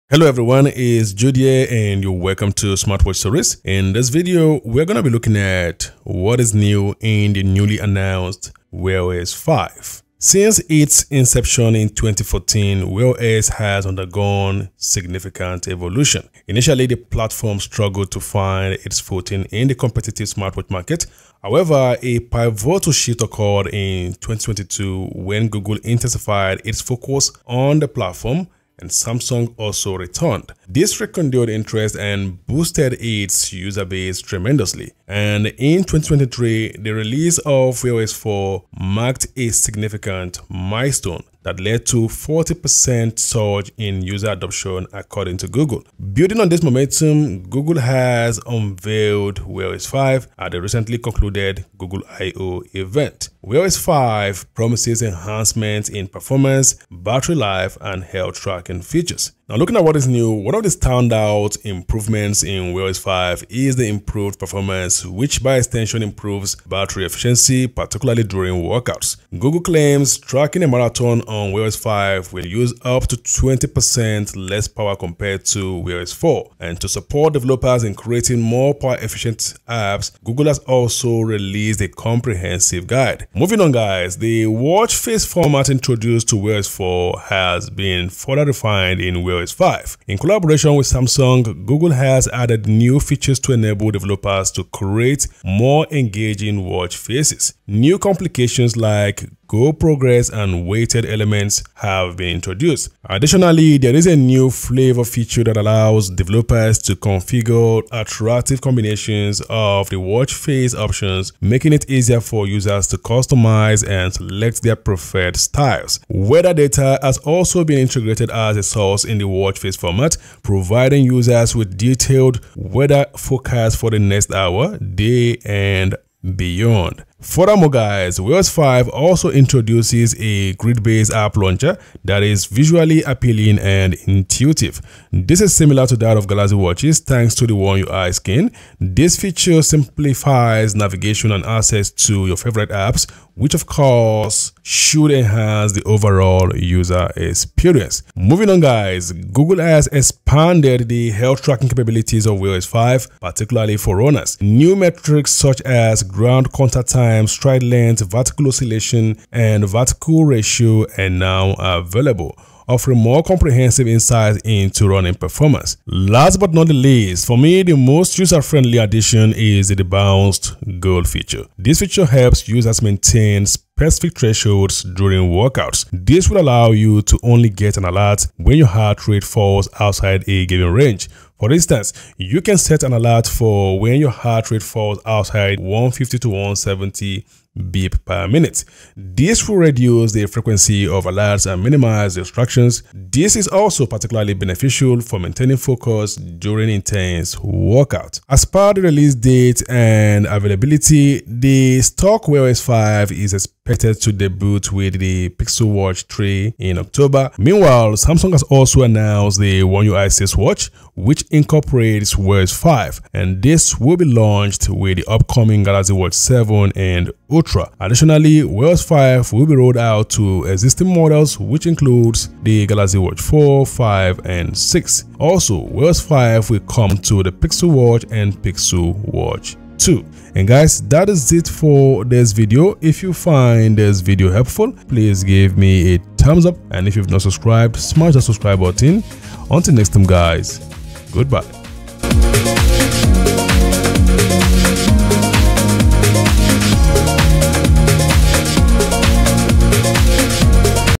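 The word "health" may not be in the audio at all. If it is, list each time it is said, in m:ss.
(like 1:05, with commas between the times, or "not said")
0:58, 2:31.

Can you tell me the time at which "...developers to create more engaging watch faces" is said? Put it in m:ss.
1:33.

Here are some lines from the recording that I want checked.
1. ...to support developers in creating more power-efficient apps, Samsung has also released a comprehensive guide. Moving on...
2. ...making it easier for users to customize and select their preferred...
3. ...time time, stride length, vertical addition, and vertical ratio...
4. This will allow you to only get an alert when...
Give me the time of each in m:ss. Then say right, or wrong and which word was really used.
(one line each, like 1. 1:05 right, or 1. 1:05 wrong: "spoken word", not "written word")
1. 1:16 wrong: "Google", not "Samsung"
2. 1:51 right
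3. 2:36 wrong: "oscillation", not "addition"
4. 2:55 right.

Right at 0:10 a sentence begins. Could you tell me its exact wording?
Since its inception in 2014, Wear OS has undergone significant evolution.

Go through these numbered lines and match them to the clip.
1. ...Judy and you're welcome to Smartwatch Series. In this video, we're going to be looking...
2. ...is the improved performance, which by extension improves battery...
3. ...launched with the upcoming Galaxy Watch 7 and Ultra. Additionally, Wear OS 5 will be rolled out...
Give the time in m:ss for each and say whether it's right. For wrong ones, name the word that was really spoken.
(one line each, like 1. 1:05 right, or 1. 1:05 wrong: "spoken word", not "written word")
1. 0:01 right
2. 1:03 right
3. 3:34 right.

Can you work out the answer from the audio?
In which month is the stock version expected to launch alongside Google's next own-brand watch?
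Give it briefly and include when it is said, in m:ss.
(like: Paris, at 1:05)
October, at 3:26.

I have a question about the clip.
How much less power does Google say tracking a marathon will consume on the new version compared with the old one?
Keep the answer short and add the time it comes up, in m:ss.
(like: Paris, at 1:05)
up to 20%, at 1:12.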